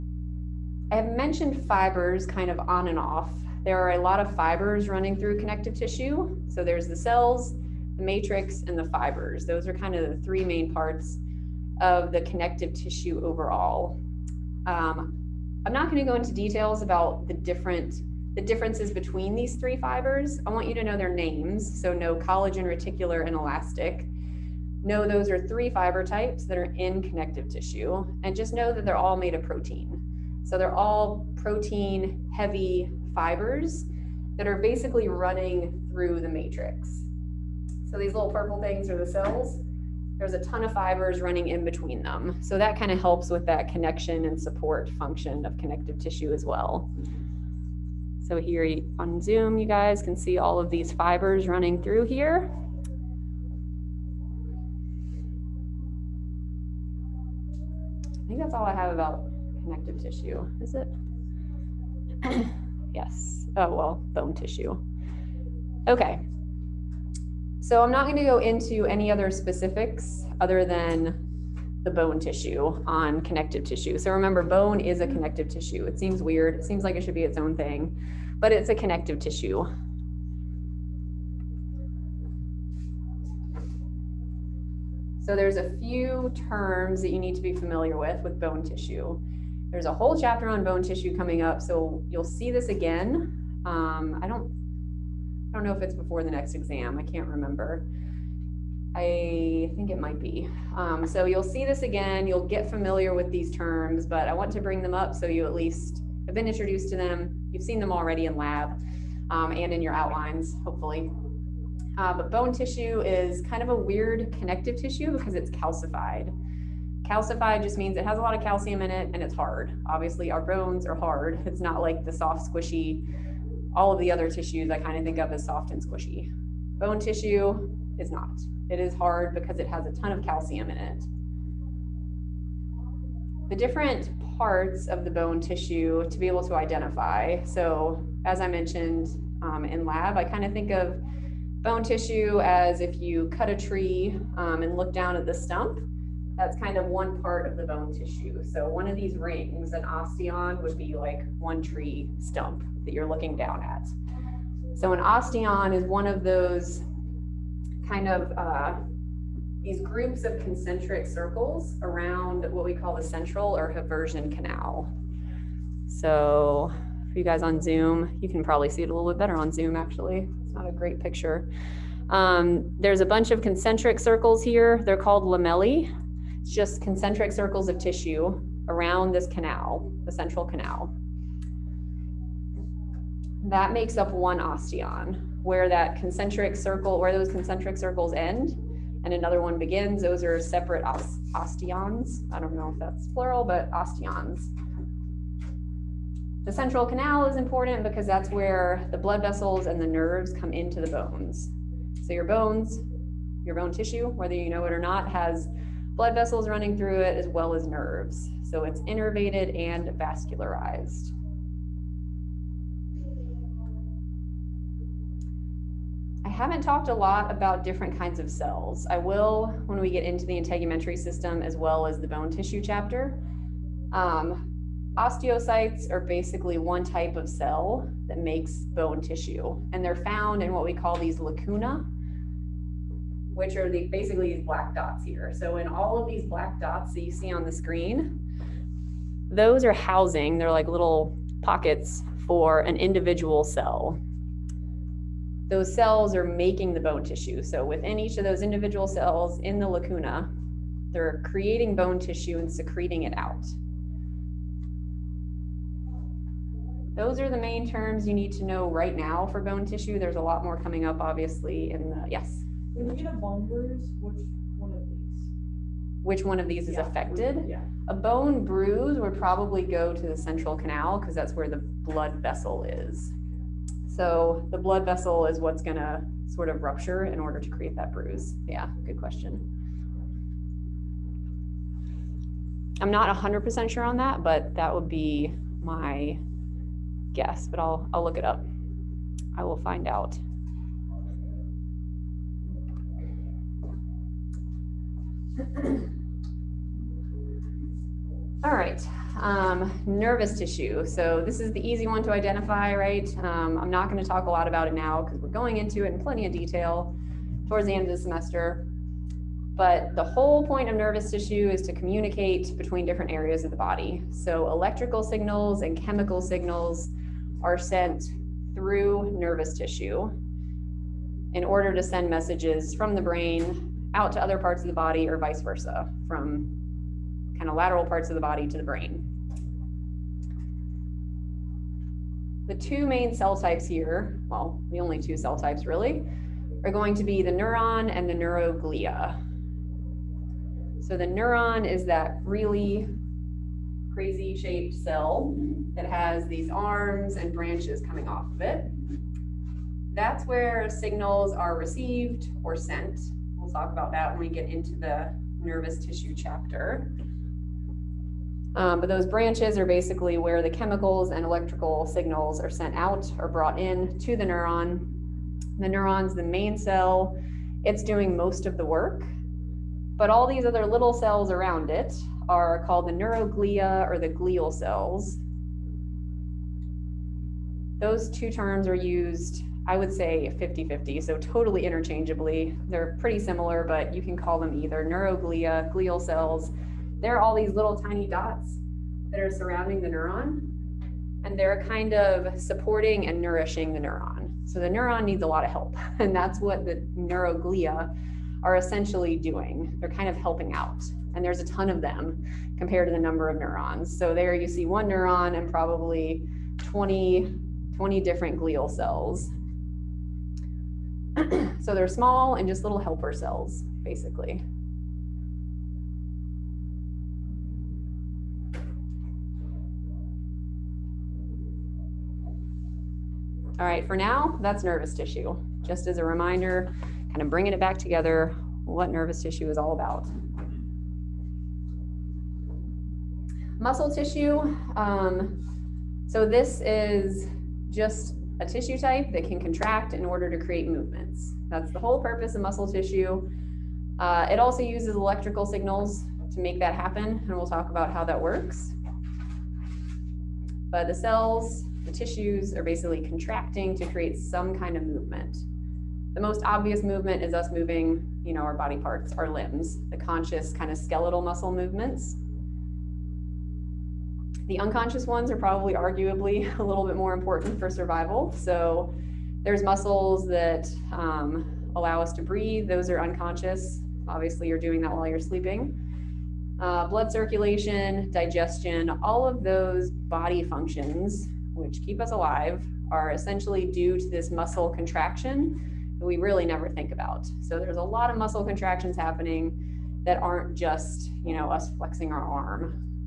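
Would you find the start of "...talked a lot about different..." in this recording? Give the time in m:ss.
3:36.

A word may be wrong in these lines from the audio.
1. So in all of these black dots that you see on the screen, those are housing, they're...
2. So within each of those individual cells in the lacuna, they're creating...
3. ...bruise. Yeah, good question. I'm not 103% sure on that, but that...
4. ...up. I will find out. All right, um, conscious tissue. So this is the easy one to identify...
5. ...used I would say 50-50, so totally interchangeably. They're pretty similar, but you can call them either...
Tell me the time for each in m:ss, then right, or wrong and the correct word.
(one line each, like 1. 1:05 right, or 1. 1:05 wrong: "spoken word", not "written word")
1. 3:55 right
2. 4:07 right
3. 4:37 wrong: "100", not "103"
4. 4:48 wrong: "nervous", not "conscious"
5. 6:18 right.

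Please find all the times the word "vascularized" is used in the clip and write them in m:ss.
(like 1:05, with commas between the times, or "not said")
3:29.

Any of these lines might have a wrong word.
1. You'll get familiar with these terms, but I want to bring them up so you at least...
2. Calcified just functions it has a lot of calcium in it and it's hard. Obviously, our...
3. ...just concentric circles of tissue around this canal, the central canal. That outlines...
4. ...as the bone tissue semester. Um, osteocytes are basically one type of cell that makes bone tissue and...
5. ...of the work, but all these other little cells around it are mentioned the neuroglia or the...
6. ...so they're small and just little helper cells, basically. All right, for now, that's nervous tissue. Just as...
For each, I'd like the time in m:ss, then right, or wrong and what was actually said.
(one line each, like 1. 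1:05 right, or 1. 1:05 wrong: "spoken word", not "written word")
1. 1:42 right
2. 1:57 wrong: "means", not "functions"
3. 2:56 wrong: "makes", not "outlines"
4. 3:41 wrong: "chapter", not "semester"
5. 6:08 wrong: "called", not "mentioned"
6. 6:51 right.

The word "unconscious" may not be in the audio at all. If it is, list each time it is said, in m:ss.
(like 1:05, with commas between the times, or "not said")
7:44, 7:52.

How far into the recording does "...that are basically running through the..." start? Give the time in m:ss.
0:34.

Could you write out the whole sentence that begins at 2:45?
So for you guys on Zoom, you can probably see it a little bit better on Zoom actually.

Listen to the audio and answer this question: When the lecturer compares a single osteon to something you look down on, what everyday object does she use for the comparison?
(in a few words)
tree stump.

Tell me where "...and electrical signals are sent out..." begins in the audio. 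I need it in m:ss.
6:01.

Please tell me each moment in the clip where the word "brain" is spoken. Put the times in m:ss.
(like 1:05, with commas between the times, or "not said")
5:23, 5:28.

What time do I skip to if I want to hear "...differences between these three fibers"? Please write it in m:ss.
0:18.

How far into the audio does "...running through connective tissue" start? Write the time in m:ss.
0:04.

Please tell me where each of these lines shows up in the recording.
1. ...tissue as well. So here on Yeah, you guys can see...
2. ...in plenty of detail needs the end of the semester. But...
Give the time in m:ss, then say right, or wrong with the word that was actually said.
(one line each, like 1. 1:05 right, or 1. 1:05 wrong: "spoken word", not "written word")
1. 0:45 wrong: "Zoom", not "Yeah"
2. 5:05 wrong: "towards", not "needs".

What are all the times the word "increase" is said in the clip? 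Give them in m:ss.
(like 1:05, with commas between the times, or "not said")
not said.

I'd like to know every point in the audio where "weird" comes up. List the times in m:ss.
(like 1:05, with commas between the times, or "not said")
1:16, 1:53.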